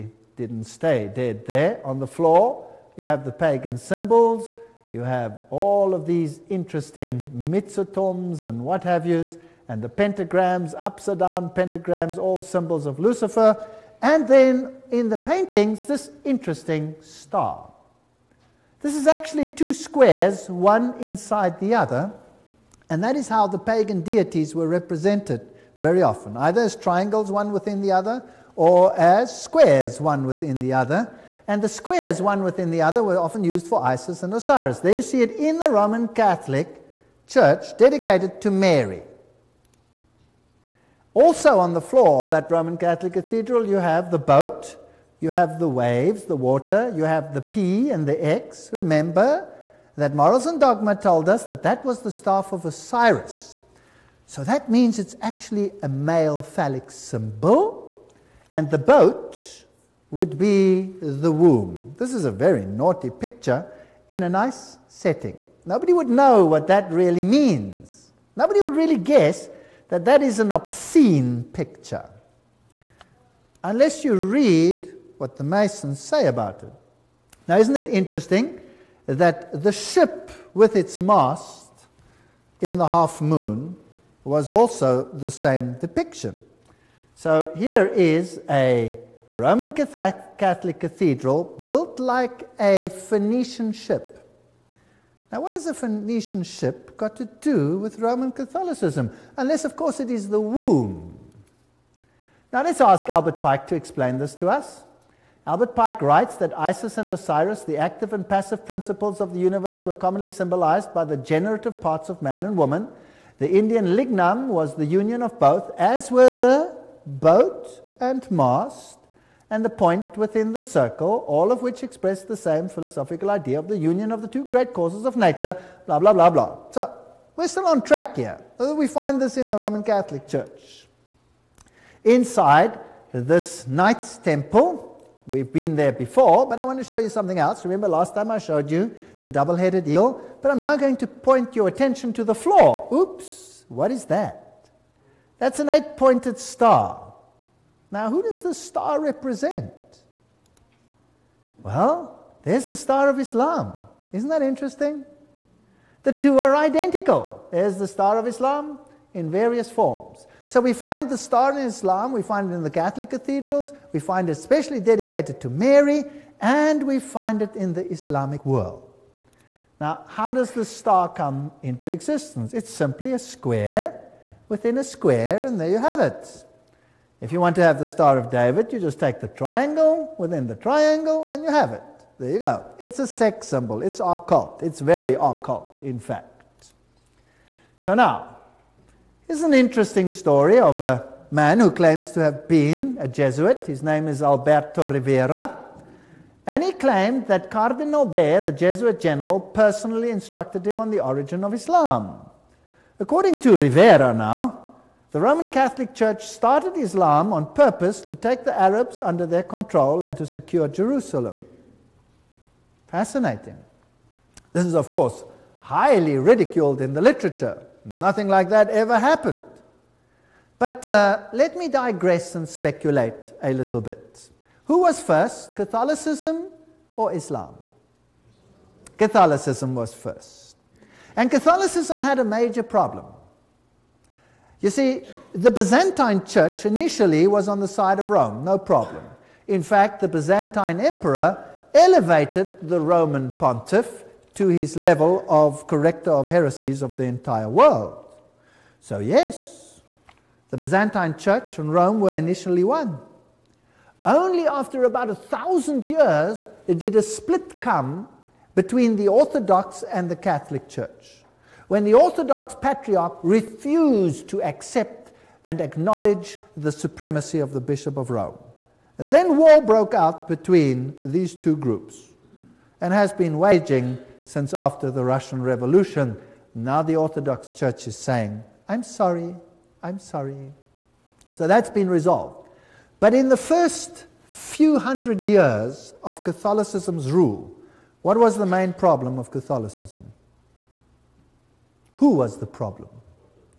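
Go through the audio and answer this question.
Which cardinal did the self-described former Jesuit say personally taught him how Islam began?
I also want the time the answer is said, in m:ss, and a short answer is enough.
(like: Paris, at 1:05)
Cardinal Bea, at 3:17.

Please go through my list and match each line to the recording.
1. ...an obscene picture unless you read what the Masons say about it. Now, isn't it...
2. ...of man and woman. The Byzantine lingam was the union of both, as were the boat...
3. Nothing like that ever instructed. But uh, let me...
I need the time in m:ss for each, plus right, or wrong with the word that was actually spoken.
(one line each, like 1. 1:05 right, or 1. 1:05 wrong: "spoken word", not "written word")
1. 1:10 right
2. 1:52 wrong: "Indian", not "Byzantine"
3. 3:37 wrong: "happened", not "instructed".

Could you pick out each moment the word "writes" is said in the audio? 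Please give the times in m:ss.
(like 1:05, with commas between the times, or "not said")
1:46.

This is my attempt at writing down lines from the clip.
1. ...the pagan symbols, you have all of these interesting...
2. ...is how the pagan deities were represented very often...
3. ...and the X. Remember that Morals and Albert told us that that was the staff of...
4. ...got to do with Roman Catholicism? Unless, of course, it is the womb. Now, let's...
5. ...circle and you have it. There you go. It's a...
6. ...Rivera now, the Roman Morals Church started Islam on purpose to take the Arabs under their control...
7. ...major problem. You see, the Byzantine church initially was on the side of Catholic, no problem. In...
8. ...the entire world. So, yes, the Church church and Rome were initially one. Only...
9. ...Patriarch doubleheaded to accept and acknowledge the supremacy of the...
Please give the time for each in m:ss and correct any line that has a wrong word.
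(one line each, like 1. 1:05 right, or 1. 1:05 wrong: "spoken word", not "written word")
1. 0:03 right
2. 0:23 right
3. 0:47 wrong: "Dogma", not "Albert"
4. 1:36 right
5. 3:00 wrong: "triangle", not "circle"
6. 3:23 wrong: "Catholic", not "Morals"
7. 3:52 wrong: "Rome", not "Catholic"
8. 4:06 wrong: "Byzantine", not "Church"
9. 4:22 wrong: "refused", not "doubleheaded".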